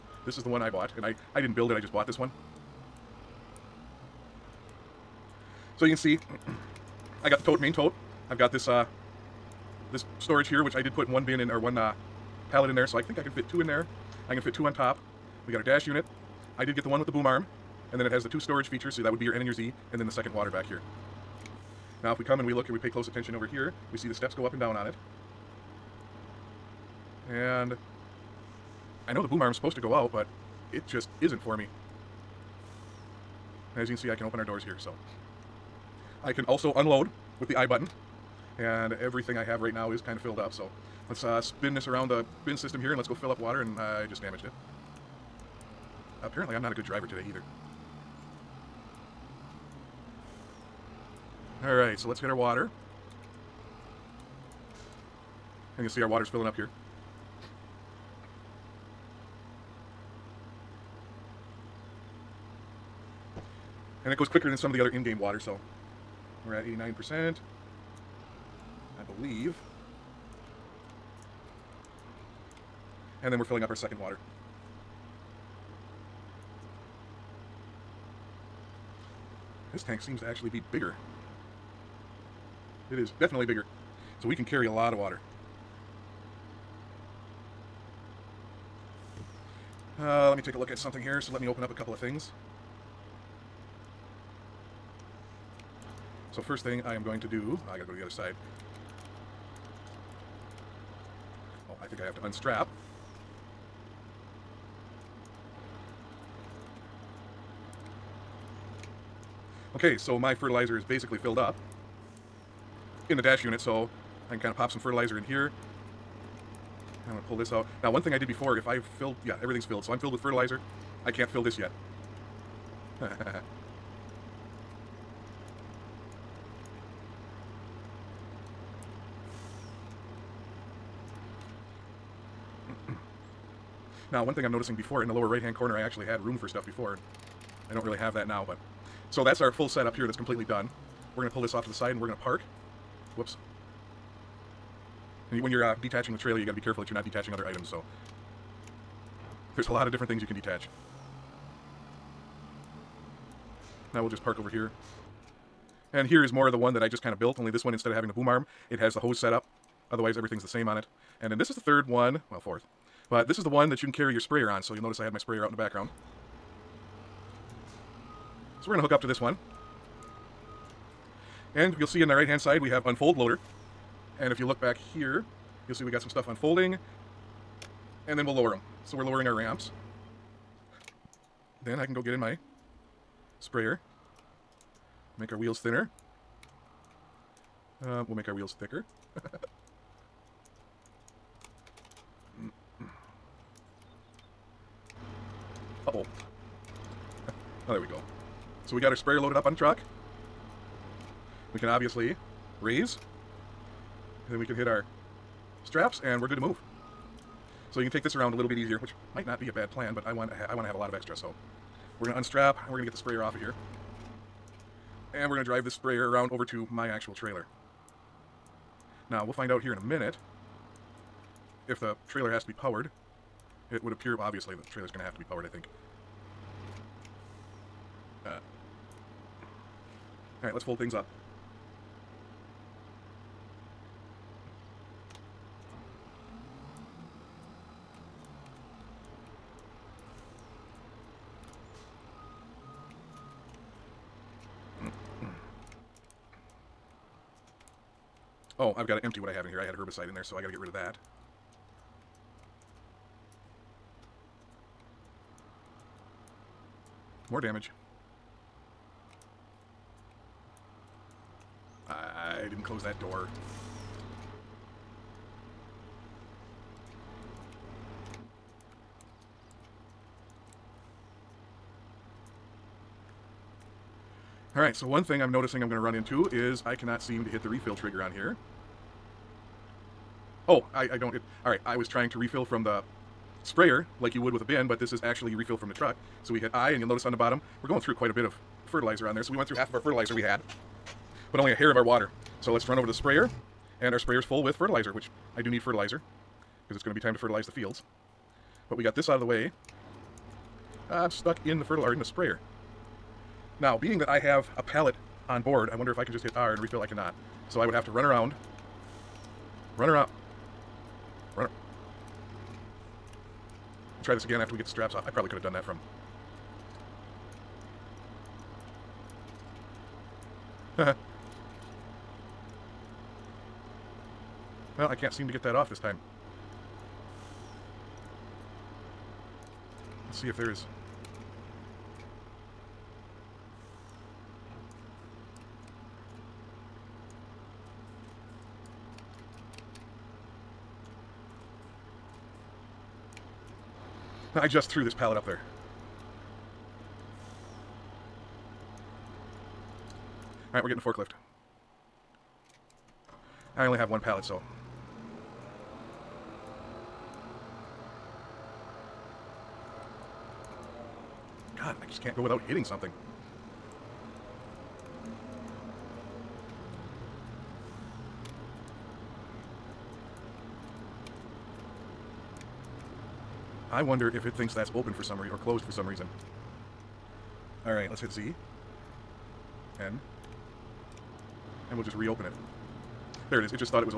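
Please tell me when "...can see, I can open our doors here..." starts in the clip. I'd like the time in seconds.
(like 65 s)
33 s.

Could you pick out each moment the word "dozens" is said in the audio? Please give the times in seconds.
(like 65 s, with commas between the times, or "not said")
not said.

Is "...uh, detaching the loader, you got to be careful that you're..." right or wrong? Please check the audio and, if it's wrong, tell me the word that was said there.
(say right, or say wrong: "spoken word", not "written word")
wrong: "trailer", not "loader".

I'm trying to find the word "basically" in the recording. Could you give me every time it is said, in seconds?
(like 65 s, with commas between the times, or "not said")
110 s.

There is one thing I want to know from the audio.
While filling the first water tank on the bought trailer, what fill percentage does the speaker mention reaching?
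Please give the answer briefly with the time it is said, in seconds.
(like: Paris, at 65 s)
89%, at 66 s.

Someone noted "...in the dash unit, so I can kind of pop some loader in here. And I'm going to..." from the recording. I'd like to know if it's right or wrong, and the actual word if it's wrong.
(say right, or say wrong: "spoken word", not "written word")
wrong: "fertilizer", not "loader".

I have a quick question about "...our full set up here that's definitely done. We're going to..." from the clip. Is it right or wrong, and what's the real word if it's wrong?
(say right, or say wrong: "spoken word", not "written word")
wrong: "completely", not "definitely".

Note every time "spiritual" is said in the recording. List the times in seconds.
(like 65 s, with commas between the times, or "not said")
not said.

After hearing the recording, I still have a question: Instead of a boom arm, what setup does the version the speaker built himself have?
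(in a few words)
hose set up.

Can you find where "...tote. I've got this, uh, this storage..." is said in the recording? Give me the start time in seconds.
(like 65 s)
7 s.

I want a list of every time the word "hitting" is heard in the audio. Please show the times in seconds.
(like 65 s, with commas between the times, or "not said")
362 s.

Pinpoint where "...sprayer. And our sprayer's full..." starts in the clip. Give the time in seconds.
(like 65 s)
292 s.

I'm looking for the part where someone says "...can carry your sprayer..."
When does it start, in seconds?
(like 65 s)
163 s.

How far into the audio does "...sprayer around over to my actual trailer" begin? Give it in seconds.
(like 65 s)
215 s.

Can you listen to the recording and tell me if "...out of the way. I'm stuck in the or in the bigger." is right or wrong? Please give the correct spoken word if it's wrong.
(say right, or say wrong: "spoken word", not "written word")
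wrong: "sprayer", not "bigger".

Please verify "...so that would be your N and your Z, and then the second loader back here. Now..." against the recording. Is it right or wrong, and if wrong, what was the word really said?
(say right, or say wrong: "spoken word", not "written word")
wrong: "water", not "loader".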